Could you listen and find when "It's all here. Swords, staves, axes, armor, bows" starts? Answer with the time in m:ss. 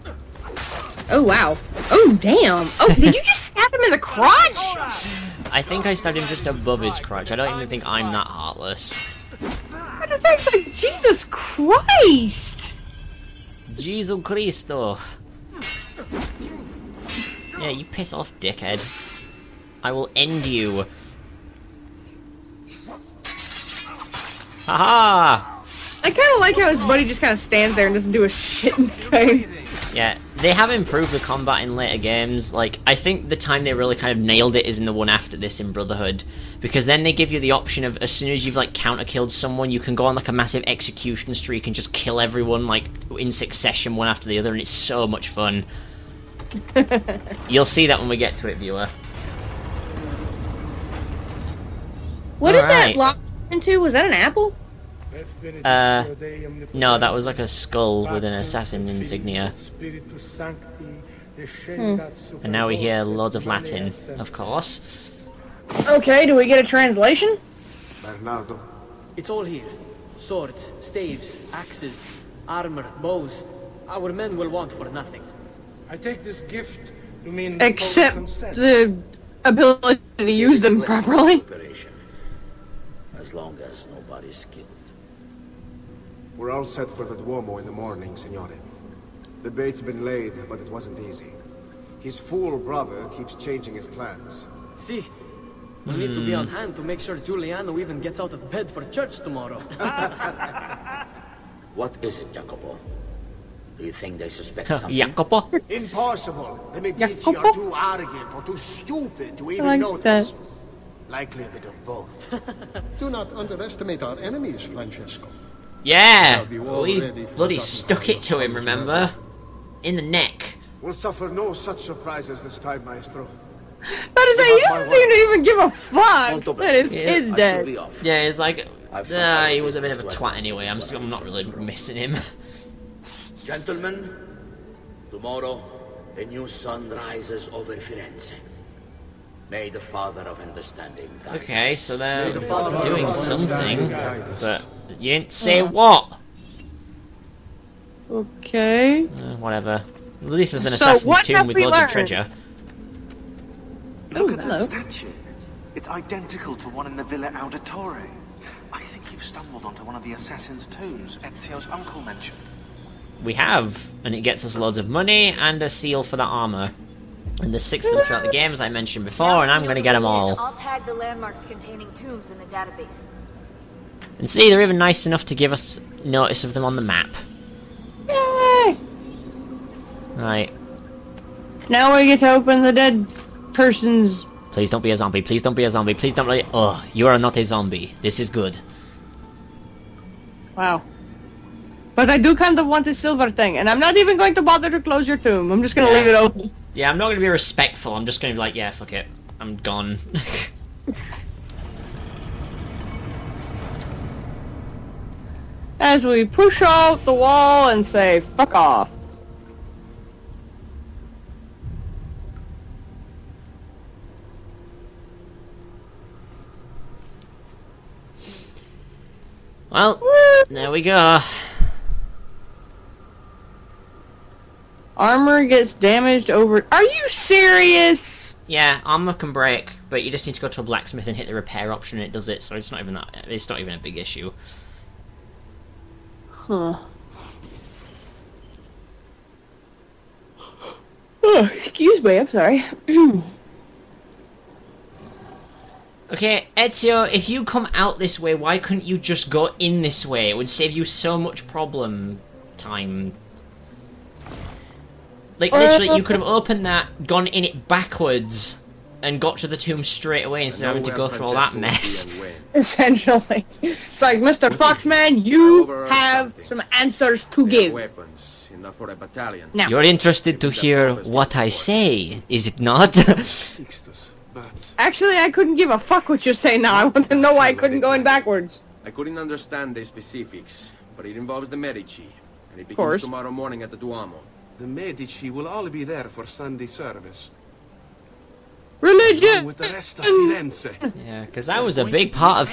1:09.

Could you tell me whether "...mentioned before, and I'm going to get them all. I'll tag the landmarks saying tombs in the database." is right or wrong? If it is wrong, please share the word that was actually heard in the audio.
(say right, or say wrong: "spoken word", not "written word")
wrong: "containing", not "saying".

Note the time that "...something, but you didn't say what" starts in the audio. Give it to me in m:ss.
2:23.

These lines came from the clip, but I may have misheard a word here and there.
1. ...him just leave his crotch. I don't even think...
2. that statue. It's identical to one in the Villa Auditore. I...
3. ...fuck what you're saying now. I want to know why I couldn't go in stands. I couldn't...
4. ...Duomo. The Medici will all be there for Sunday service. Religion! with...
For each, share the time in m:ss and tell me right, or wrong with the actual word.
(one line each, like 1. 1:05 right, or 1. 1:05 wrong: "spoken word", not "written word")
1. 0:06 wrong: "above", not "leave"
2. 2:34 right
3. 4:35 wrong: "backwards", not "stands"
4. 4:43 right.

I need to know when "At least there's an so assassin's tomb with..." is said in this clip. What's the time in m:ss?
2:30.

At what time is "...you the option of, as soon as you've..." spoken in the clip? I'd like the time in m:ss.
0:37.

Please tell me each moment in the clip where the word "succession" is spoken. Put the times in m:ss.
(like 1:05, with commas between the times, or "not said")
0:43.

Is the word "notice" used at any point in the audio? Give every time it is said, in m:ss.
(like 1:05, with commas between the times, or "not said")
1:49, 2:56.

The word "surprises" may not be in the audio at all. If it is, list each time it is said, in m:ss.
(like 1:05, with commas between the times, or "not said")
2:01.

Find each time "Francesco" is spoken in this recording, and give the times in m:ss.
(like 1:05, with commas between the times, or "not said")
1:54.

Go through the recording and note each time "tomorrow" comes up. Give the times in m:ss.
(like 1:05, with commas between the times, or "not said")
1:39, 2:15, 4:43.